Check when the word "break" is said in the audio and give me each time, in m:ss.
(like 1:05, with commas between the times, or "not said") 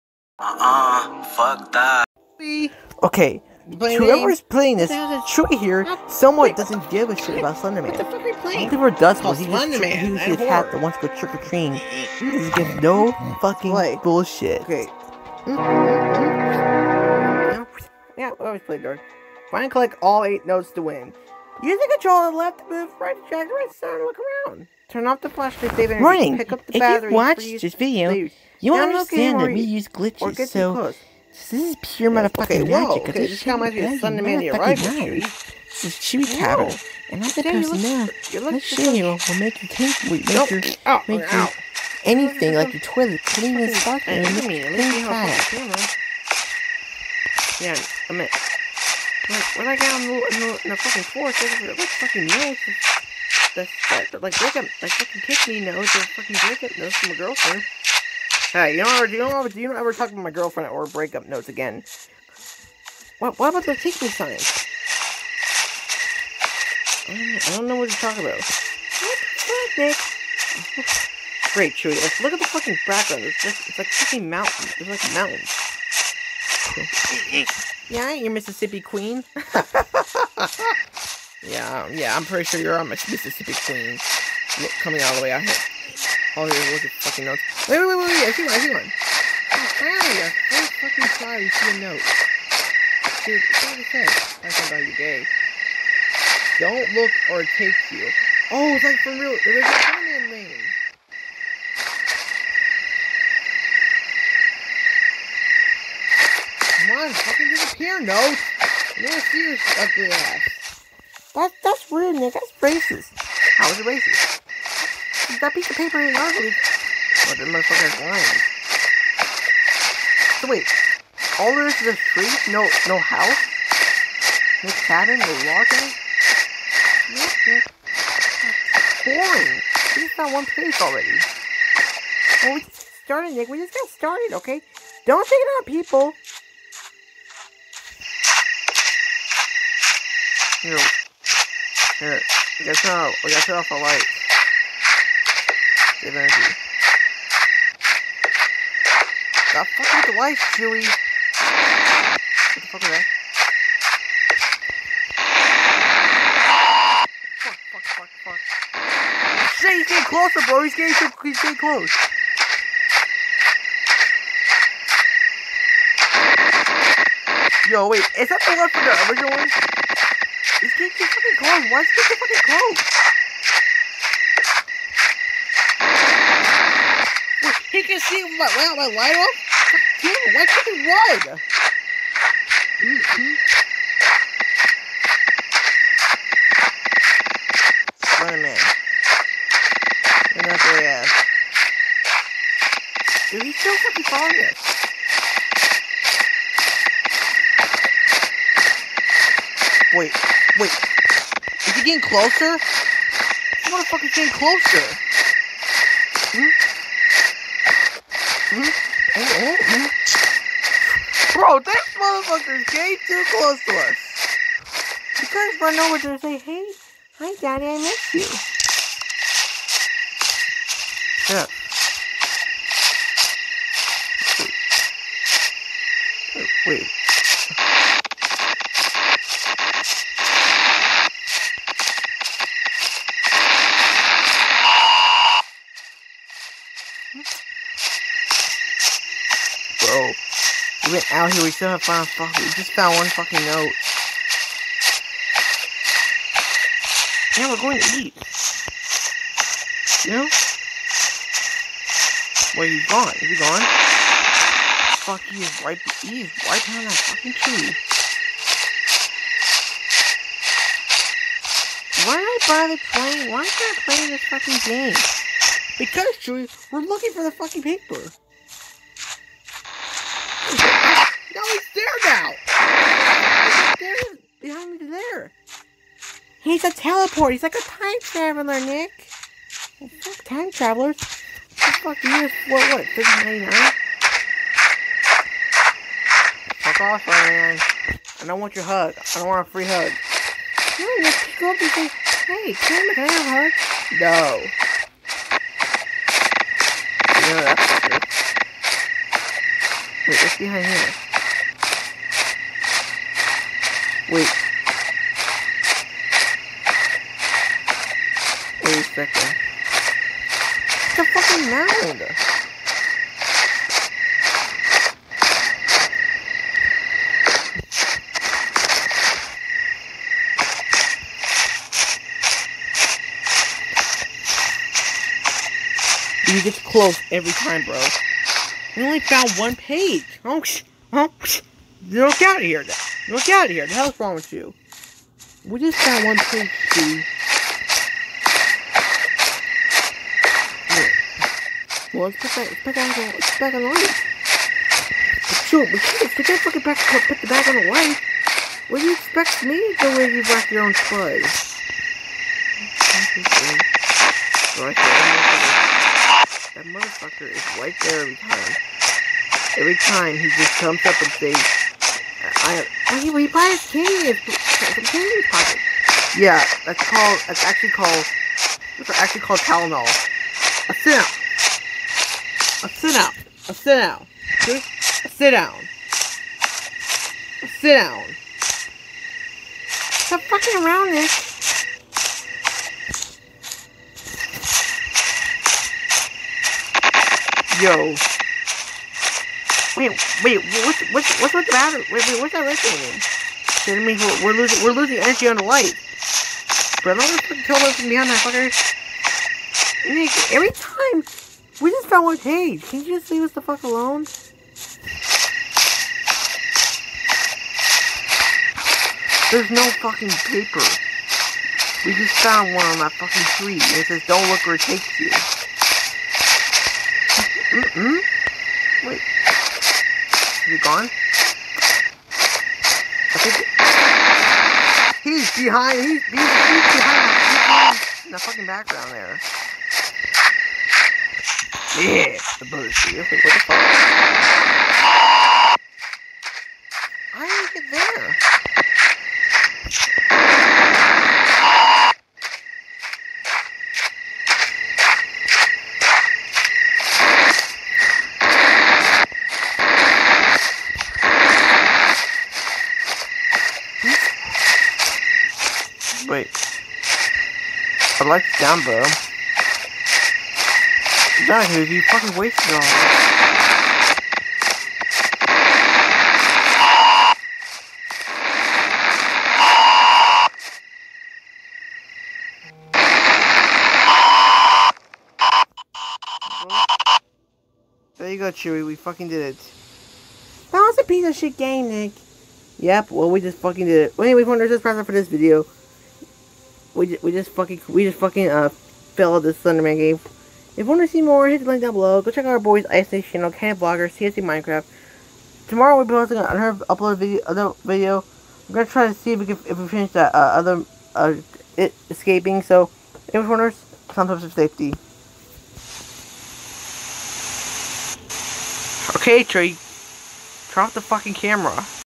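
0:54, 1:00.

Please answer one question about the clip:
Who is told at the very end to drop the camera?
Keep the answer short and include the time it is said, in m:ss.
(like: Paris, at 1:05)
Trey, at 8:29.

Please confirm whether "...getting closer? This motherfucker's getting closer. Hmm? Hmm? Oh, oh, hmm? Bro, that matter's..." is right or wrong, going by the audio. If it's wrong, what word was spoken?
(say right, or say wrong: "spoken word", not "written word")
wrong: "motherfucker", not "matter".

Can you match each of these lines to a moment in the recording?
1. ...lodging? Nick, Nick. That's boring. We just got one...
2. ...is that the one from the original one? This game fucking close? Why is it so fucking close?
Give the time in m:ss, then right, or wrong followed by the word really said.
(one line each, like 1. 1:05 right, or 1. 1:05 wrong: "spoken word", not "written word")
1. 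2:05 right
2. 2:48 right.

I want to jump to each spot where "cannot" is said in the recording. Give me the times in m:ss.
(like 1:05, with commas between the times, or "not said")
not said.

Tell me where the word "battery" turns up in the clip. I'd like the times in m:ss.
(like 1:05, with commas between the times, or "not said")
0:26.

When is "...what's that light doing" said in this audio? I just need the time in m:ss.
6:32.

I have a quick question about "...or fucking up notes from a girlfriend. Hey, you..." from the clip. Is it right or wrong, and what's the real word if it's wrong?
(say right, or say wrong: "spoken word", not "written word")
right.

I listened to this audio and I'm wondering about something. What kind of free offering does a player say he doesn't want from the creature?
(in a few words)
a hug.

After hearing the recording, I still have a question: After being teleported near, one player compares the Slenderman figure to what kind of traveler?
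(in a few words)
time traveler.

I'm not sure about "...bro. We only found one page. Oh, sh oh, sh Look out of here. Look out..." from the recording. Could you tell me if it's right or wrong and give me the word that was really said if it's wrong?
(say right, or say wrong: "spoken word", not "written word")
right.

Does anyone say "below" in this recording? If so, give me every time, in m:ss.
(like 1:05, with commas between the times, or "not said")
8:11.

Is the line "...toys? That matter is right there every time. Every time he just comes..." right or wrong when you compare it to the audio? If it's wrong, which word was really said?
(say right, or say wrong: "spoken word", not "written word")
wrong: "motherfucker", not "matter".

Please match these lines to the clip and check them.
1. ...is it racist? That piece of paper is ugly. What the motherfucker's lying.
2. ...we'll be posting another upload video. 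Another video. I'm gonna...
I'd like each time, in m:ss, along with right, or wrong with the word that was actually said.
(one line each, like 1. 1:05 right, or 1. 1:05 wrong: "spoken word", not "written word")
1. 1:53 right
2. 8:15 right.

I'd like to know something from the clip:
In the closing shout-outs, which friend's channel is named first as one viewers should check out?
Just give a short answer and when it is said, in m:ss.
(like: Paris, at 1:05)
Ice Knight, at 8:12.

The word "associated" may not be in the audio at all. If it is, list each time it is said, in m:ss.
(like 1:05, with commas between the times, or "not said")
not said.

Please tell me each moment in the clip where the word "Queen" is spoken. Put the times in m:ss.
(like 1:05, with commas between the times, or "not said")
1:18, 1:23.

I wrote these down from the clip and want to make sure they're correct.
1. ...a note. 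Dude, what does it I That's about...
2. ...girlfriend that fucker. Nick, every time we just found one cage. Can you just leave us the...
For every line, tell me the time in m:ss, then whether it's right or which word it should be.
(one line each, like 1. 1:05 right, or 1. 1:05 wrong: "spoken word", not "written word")
1. 1:31 right
2. 6:37 wrong: "behind", not "girlfriend".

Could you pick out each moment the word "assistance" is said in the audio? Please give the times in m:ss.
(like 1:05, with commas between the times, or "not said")
not said.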